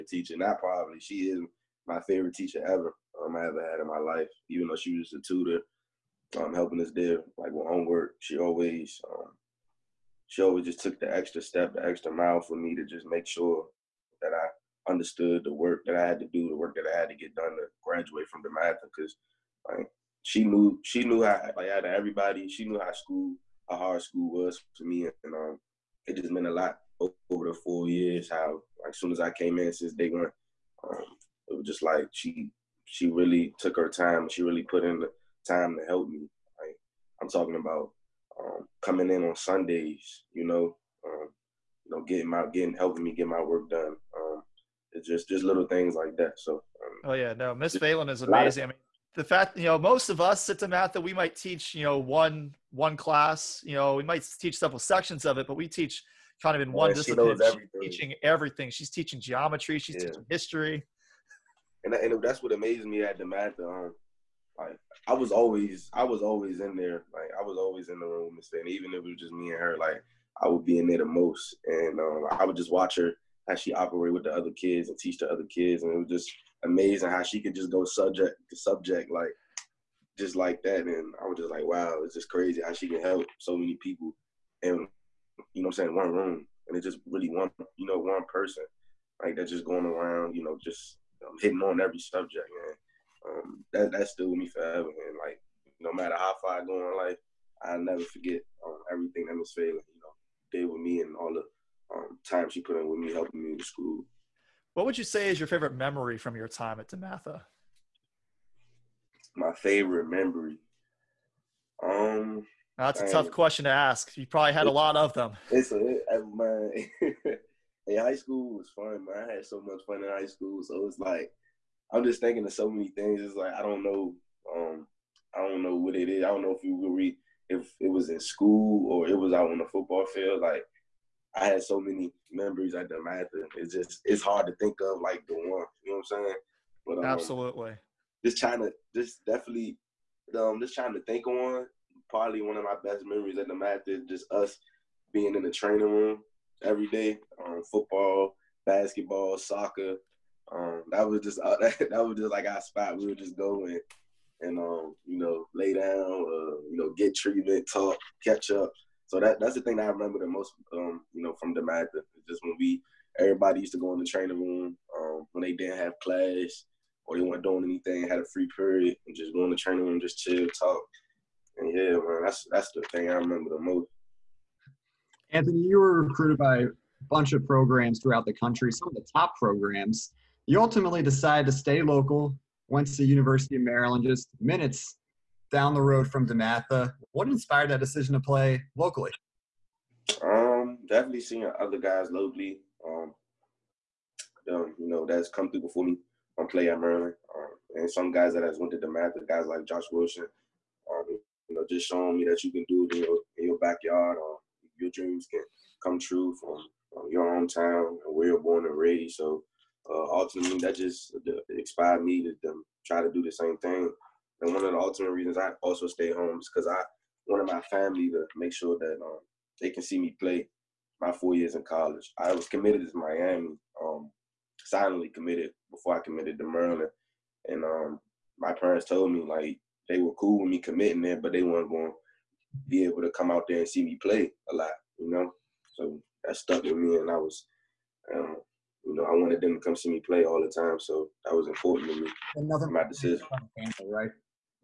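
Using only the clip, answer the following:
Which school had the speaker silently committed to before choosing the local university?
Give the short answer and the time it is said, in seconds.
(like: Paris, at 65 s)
Miami, at 222 s.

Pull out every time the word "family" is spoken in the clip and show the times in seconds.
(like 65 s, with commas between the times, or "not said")
217 s, 243 s.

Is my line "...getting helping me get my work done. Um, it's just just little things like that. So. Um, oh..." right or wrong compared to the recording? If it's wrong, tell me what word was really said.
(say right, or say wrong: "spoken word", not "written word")
right.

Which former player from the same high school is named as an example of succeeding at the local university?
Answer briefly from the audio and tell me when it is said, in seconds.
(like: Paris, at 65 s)
Josh Wilson, at 199 s.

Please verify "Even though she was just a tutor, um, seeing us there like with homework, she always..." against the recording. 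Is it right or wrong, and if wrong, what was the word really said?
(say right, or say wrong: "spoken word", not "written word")
wrong: "helping", not "seeing".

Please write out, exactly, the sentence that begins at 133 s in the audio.
It's just, it's hard to think of like the one, you know what I'm saying?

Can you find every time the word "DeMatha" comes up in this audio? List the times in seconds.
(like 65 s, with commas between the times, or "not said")
18 s, 63 s, 106 s, 132 s, 143 s, 161 s, 186 s, 198 s.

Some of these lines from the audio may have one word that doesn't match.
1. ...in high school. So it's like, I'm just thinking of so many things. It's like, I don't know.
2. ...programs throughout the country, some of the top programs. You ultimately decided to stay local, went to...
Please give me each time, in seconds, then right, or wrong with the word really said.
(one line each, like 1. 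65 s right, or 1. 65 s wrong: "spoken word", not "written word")
1. 120 s right
2. 177 s right.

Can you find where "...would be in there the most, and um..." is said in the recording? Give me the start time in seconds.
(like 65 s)
70 s.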